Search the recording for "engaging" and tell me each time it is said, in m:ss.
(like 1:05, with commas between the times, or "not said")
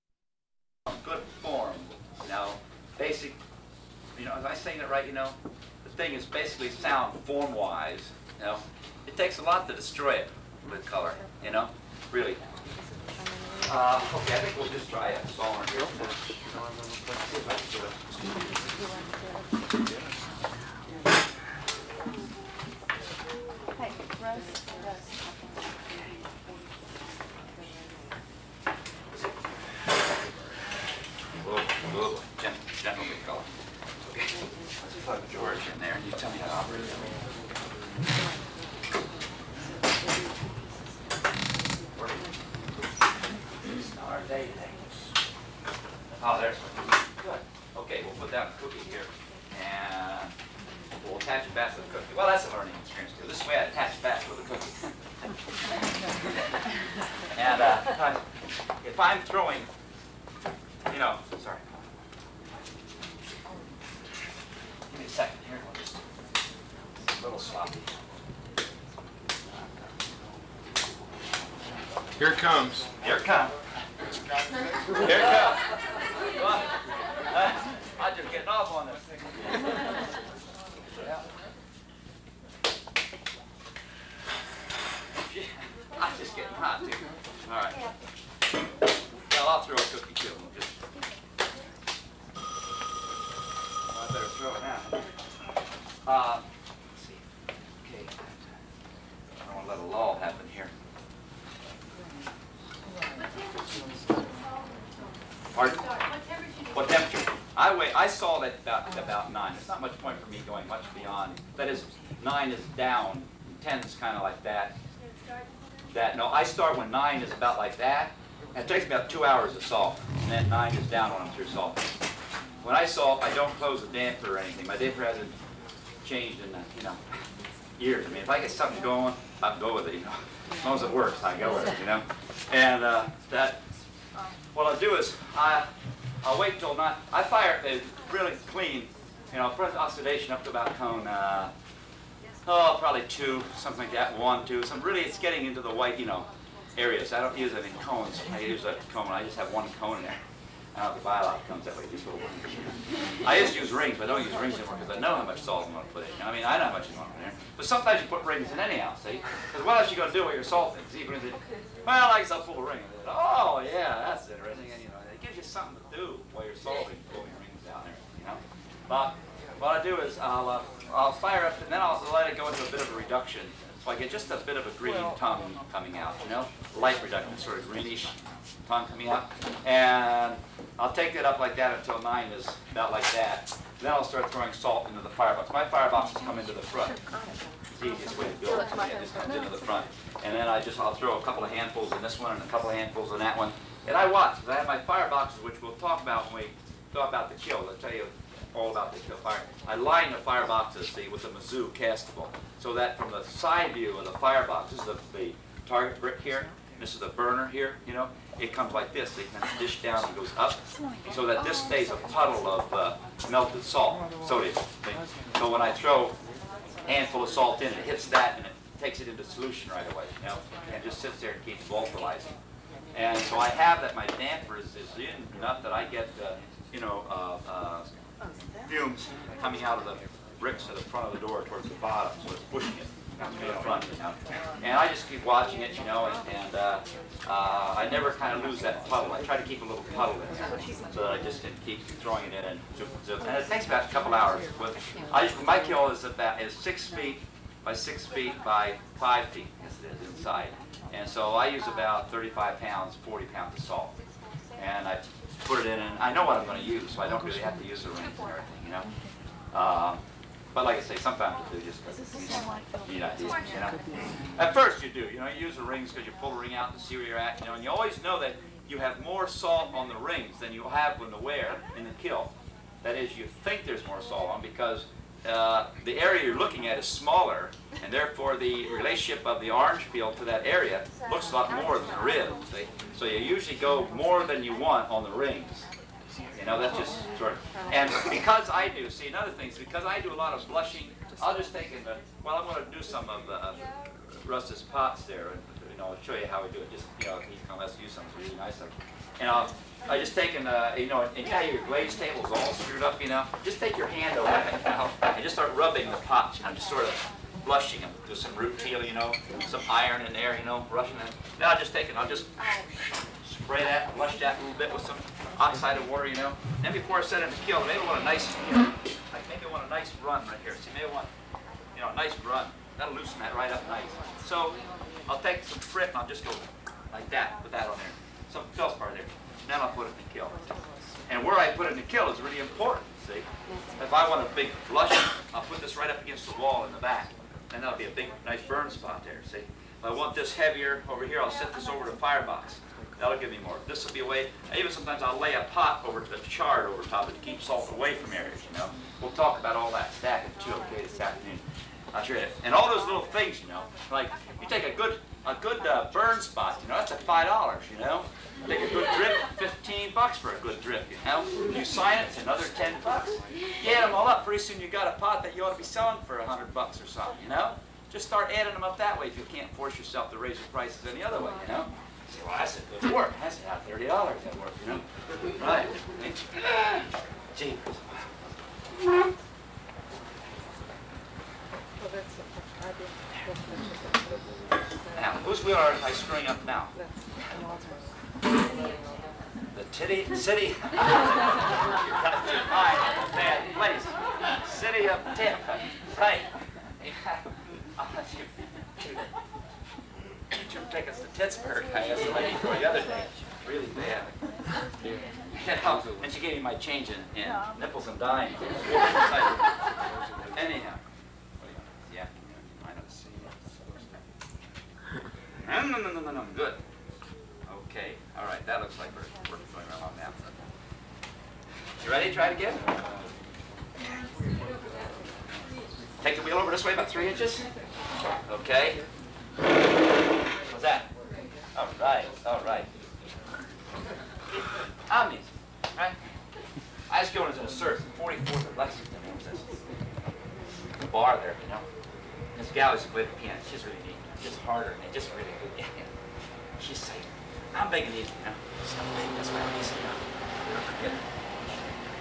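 not said.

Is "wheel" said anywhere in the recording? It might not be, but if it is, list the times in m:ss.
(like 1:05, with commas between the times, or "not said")
6:25, 7:06.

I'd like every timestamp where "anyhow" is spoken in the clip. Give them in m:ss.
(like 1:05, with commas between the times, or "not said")
2:38, 6:50.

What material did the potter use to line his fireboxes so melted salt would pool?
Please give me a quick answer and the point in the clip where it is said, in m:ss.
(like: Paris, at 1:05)
Mizzou castable, at 3:21.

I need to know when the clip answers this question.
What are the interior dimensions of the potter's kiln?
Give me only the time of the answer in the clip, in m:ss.
4:06.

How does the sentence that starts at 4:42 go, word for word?
So you usually go more than you want on the rings.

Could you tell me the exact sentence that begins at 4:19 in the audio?
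Um, but like I say, sometimes you do just because you need you know.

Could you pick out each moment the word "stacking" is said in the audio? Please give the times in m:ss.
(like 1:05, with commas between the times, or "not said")
5:49.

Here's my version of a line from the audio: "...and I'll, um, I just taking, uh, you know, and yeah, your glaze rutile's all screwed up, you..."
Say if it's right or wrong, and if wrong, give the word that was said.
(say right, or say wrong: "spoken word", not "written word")
wrong: "table", not "rutile".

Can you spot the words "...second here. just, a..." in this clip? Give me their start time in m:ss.
1:05.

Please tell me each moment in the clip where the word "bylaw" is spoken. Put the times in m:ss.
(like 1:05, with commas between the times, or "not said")
2:31.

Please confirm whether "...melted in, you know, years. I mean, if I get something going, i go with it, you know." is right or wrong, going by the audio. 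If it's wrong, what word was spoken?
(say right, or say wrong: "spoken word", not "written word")
wrong: "changed", not "melted".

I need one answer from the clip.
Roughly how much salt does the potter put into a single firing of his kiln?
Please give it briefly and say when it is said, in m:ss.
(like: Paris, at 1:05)
35 to 40 pounds, at 4:12.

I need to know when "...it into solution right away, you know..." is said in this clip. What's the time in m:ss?
3:39.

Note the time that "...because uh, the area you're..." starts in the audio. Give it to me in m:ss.
4:34.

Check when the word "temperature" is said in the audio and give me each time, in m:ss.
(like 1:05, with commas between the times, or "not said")
1:46.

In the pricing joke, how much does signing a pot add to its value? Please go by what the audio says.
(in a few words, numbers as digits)
$10.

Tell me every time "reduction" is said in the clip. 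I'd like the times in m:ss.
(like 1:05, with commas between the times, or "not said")
2:52, 2:57.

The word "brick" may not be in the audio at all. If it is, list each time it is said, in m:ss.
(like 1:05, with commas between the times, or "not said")
3:26, 3:50.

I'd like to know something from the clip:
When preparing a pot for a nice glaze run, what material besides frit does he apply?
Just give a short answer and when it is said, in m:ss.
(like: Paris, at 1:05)
feldspar, at 5:28.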